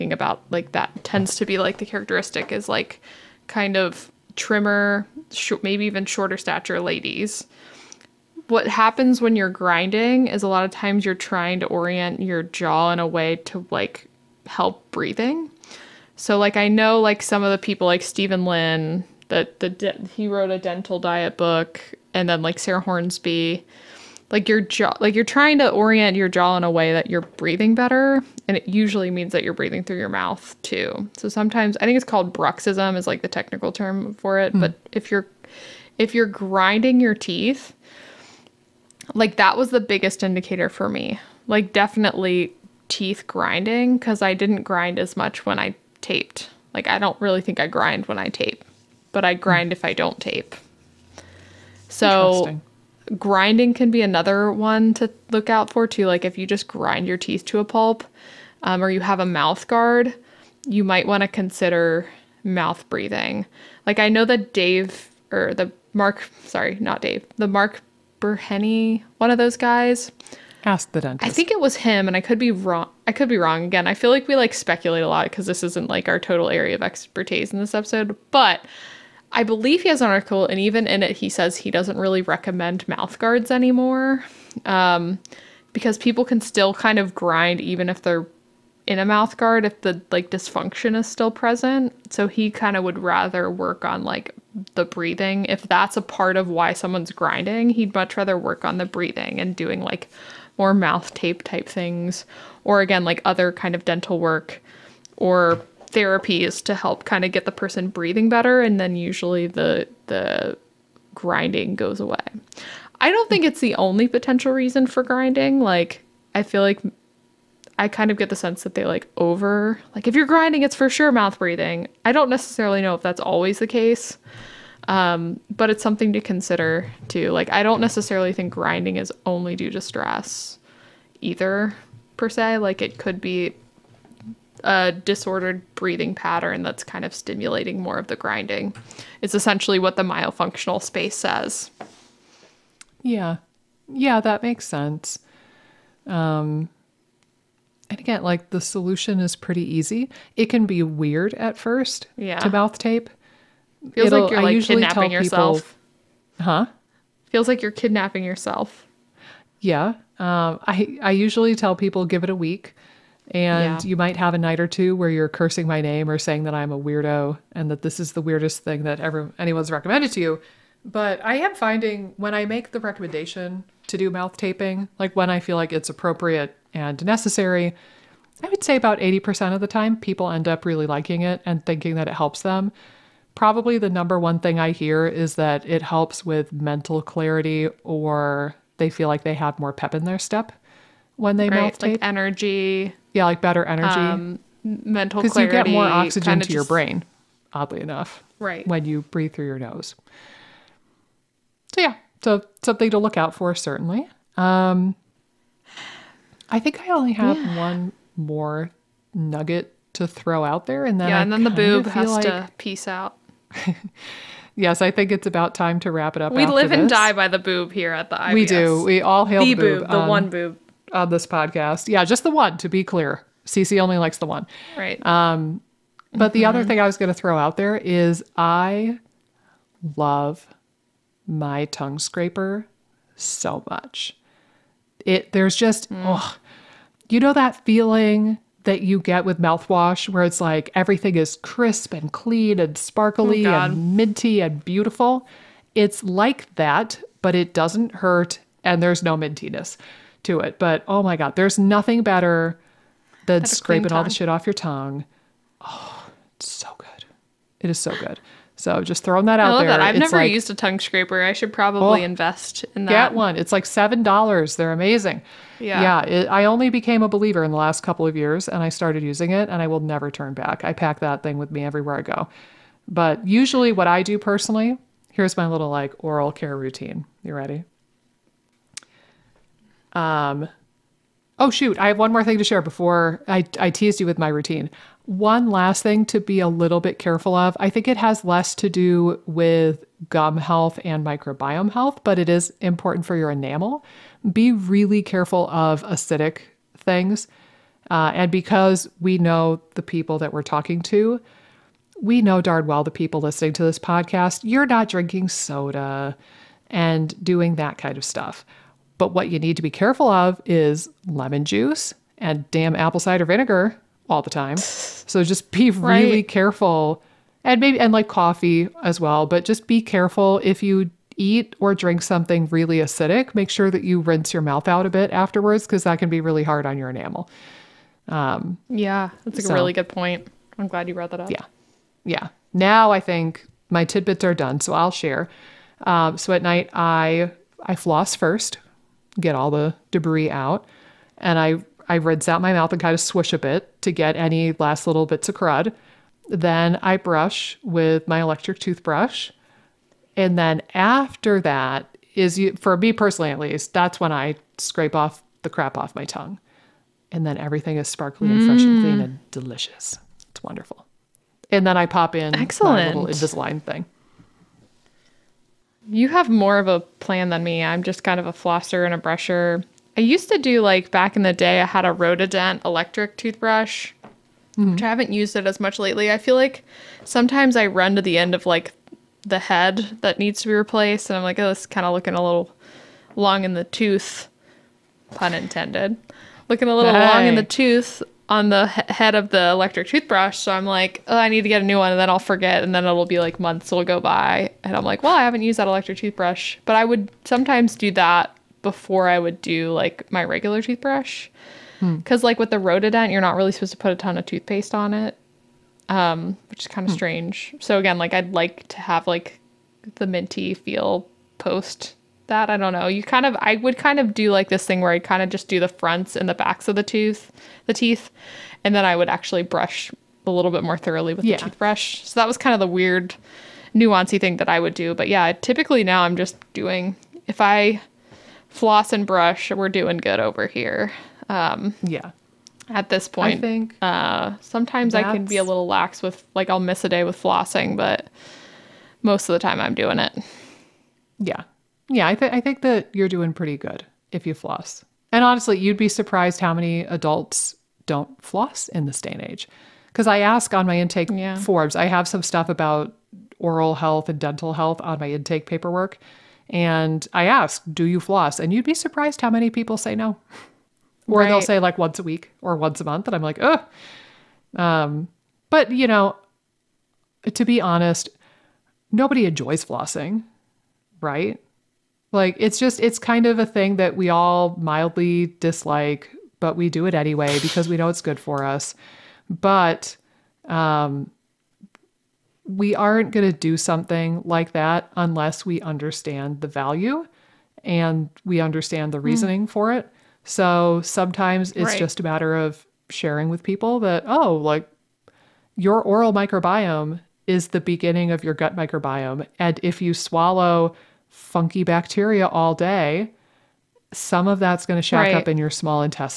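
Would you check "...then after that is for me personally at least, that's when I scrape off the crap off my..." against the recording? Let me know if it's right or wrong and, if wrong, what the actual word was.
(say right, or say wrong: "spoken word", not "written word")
right.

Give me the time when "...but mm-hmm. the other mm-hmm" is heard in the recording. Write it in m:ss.
3:46.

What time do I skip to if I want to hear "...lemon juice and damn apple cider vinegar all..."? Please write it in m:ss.
5:11.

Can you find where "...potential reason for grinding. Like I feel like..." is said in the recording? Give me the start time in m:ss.
1:54.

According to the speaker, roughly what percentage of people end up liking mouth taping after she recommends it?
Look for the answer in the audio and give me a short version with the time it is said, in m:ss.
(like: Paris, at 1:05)
80%, at 2:58.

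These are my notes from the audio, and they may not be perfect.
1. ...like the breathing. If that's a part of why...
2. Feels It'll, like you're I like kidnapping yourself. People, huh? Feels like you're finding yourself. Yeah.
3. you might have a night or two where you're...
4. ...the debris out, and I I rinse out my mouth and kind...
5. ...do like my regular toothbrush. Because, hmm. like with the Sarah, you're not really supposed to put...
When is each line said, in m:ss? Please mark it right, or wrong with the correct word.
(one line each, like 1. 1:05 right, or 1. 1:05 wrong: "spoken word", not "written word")
1. 1:34 right
2. 2:33 wrong: "kidnapping", not "finding"
3. 2:43 right
4. 5:39 right
5. 6:39 wrong: "Rotadent", not "Sarah".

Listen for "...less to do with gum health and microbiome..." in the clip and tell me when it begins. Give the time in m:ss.
4:48.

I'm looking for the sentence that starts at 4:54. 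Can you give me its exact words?
Be really careful of acidic things.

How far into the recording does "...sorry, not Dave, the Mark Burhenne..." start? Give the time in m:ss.
1:06.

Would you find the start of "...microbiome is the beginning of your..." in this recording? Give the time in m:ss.
8:16.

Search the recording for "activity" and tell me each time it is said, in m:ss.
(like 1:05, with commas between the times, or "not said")
not said.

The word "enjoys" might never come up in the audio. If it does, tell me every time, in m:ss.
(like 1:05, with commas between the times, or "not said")
7:49.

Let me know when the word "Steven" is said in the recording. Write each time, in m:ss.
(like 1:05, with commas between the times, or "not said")
0:18.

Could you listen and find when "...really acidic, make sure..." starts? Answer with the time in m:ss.
5:22.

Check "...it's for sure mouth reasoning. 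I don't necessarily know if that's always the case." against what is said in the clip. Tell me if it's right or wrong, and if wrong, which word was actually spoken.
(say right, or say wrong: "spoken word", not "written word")
wrong: "breathing", not "reasoning".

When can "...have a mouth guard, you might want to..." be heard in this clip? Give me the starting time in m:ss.
0:58.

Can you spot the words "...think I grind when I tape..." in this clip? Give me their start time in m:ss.
0:47.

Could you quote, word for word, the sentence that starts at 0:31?
So sometimes I think it's called bruxism is like the technical term for it, mm.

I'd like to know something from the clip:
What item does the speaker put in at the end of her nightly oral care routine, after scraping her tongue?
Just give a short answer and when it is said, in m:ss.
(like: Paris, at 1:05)
Invisalign, at 6:03.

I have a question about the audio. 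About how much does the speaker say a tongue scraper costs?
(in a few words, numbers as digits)
$7.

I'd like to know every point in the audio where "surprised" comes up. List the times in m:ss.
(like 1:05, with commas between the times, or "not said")
7:25, 7:38.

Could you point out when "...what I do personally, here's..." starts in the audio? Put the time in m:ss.
4:33.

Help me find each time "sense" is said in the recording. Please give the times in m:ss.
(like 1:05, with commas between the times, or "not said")
1:58, 2:24.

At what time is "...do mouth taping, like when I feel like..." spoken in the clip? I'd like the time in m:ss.
2:53.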